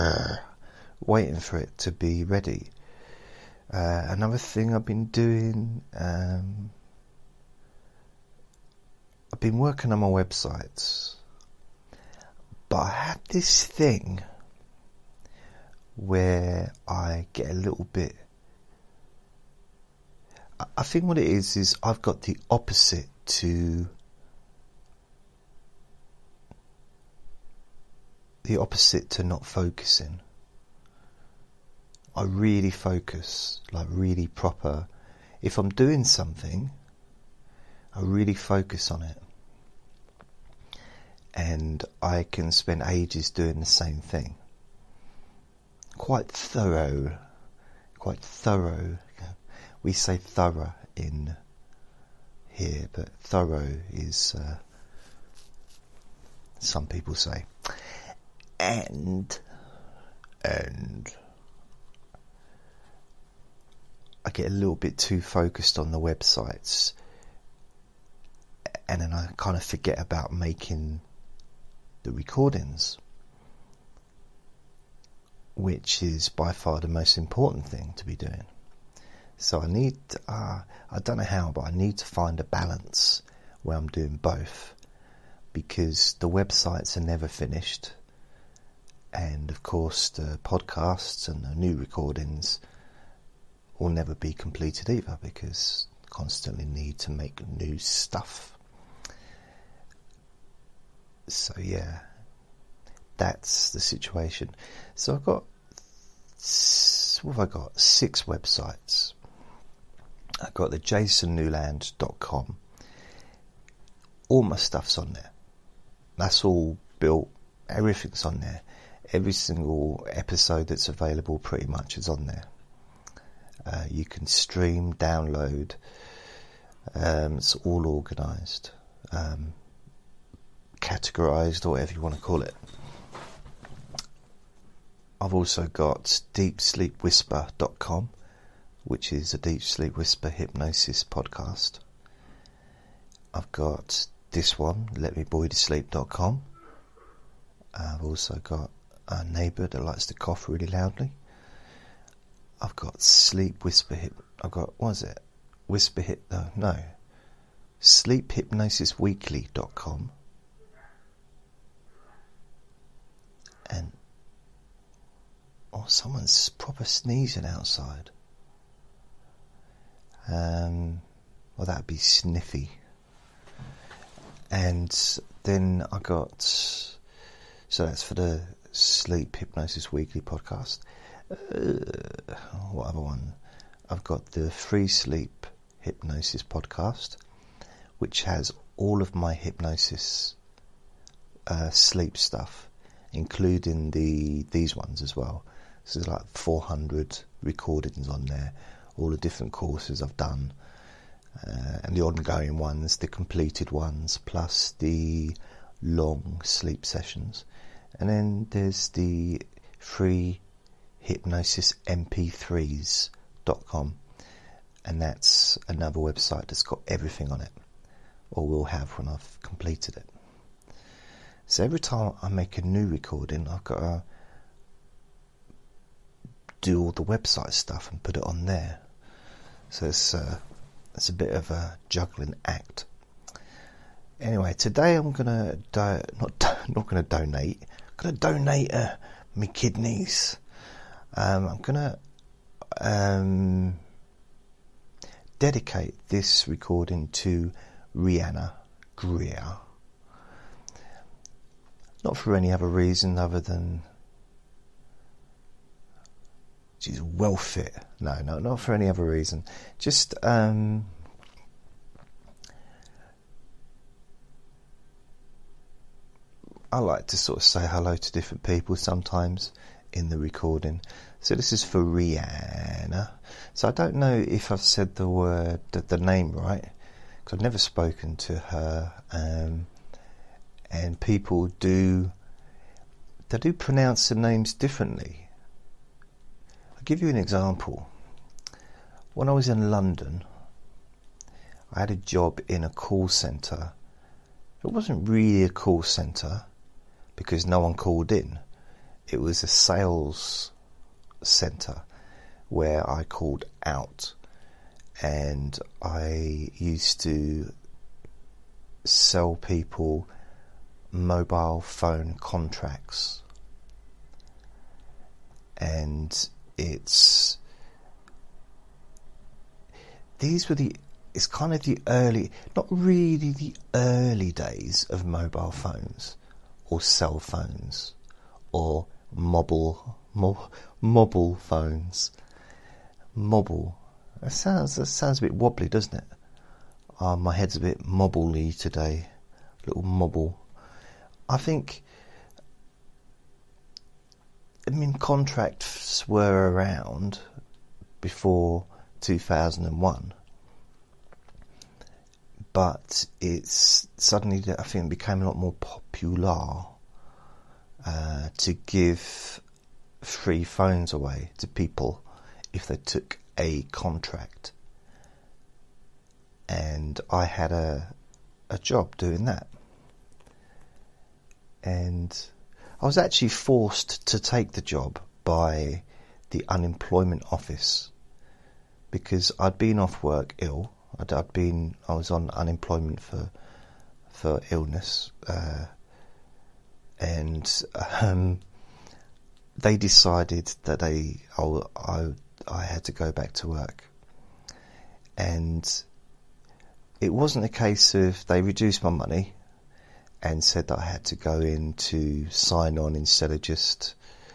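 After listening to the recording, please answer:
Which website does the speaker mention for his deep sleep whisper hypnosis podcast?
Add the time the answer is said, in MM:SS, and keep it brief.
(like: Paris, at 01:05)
deepsleepwhisper.com, at 02:16.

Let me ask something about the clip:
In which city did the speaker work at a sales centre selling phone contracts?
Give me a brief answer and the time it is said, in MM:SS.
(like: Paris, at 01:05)
London, at 04:49.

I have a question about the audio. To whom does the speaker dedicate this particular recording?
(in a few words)
Rihanna Greer.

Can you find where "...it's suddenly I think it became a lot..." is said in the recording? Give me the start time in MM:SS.
05:53.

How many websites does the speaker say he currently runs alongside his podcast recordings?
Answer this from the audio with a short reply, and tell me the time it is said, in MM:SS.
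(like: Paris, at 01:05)
6, at 01:47.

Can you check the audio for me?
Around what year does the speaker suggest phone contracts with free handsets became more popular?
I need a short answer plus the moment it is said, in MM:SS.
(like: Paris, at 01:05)
2001, at 05:48.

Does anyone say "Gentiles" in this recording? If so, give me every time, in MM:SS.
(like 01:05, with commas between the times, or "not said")
not said.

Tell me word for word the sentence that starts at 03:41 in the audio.
So every time I make a new recording, I've got to do all the website stuff and put it on there.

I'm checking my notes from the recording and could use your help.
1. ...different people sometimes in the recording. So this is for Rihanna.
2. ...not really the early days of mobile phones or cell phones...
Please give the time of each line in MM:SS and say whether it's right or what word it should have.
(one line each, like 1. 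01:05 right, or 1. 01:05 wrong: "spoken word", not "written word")
1. 04:28 right
2. 05:22 right.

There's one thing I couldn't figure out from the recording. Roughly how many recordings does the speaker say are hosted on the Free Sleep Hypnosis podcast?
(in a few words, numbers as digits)
400.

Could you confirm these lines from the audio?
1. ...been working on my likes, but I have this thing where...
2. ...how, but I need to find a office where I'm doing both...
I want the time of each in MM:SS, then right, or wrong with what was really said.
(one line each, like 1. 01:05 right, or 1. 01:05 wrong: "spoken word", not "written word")
1. 00:09 wrong: "websites", not "likes"
2. 01:21 wrong: "balance", not "office".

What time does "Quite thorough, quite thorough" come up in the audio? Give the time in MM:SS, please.
00:45.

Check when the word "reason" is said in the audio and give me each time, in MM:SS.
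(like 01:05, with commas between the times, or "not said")
04:12, 04:19.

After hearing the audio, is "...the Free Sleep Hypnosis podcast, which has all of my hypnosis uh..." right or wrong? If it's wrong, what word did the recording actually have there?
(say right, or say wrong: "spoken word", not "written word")
right.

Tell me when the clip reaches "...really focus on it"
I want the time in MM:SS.
00:38.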